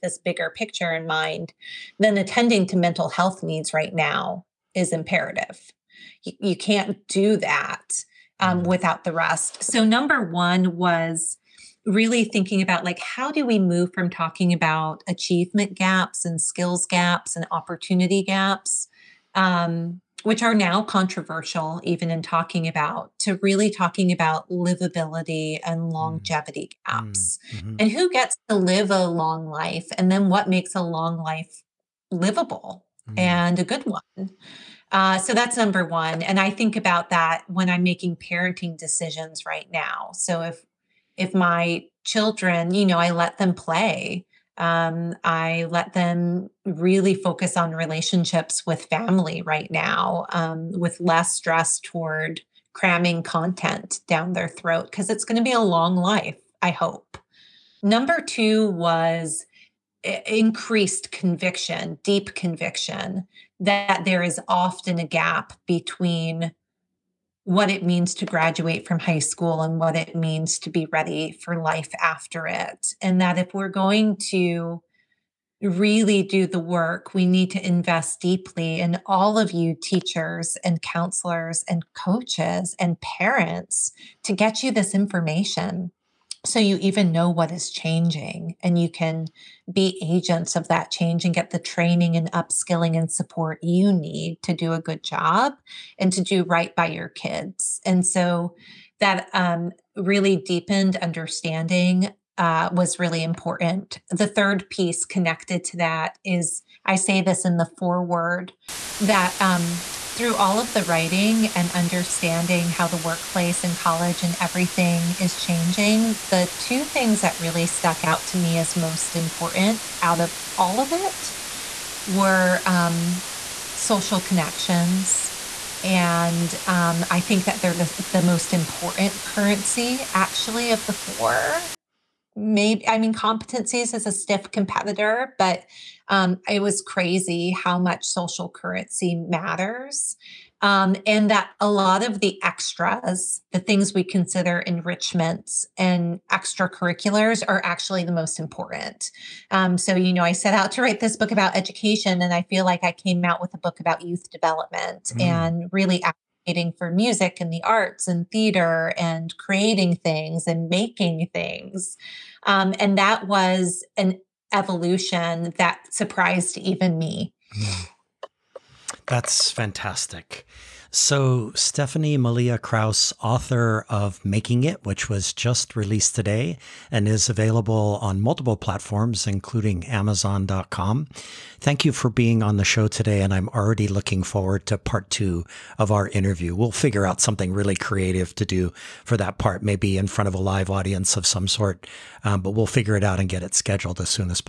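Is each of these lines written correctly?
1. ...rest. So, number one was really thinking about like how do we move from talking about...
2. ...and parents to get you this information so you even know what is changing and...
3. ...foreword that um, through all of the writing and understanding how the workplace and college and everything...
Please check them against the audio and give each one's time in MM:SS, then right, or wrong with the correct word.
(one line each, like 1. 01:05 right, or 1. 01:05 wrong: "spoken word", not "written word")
1. 00:09 right
2. 01:22 right
3. 01:47 right.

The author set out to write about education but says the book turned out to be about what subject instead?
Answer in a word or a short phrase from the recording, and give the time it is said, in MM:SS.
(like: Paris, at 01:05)
youth development, at 02:34.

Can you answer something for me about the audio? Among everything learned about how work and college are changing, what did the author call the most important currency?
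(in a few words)
social connections.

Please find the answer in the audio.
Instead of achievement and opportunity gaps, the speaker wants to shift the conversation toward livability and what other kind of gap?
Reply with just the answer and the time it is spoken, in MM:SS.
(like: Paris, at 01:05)
longevity gaps, at 00:25.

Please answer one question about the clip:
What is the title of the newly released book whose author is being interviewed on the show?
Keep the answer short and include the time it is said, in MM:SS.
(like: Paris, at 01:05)
Making It, at 02:54.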